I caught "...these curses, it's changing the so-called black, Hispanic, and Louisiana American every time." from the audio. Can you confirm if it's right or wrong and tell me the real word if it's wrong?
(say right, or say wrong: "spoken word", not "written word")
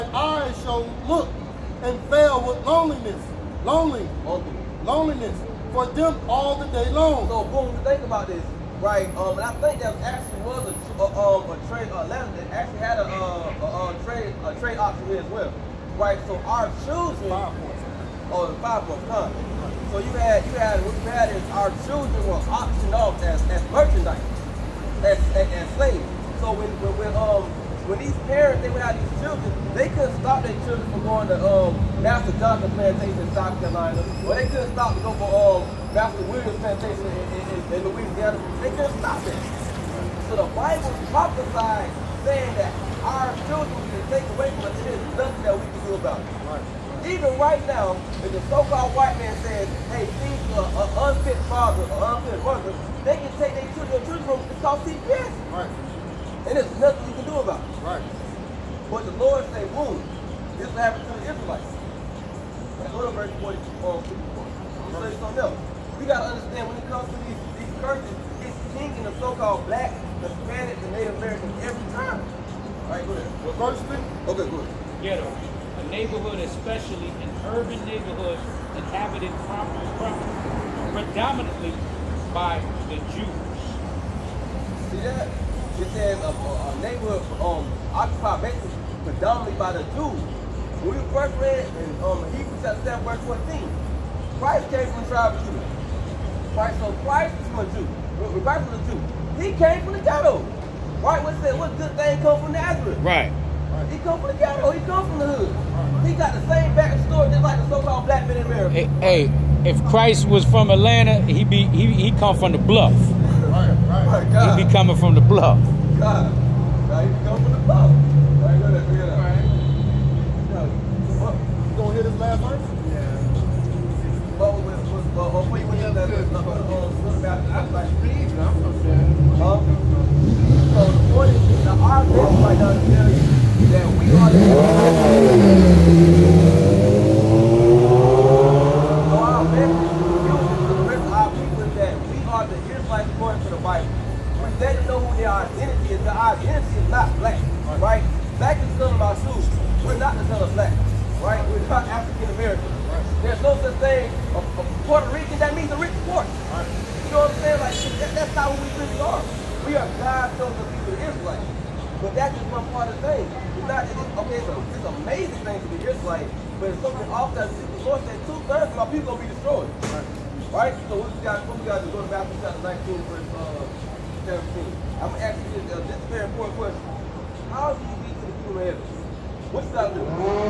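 wrong: "Native", not "Louisiana".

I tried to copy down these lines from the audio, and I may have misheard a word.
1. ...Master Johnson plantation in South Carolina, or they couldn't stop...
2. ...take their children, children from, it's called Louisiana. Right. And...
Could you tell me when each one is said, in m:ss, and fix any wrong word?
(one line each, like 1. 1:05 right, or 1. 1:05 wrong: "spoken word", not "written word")
1. 0:31 right
2. 0:53 wrong: "CPS", not "Louisiana".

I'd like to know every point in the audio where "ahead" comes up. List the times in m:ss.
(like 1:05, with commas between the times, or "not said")
1:13.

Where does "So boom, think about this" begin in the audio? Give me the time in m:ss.
0:07.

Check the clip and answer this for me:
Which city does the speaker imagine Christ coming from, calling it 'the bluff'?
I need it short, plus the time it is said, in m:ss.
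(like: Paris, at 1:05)
Atlanta, at 1:50.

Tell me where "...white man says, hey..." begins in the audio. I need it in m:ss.
0:48.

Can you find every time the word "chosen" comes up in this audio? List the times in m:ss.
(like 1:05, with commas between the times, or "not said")
2:40.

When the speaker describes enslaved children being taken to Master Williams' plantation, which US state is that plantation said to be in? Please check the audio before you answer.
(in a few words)
Louisiana.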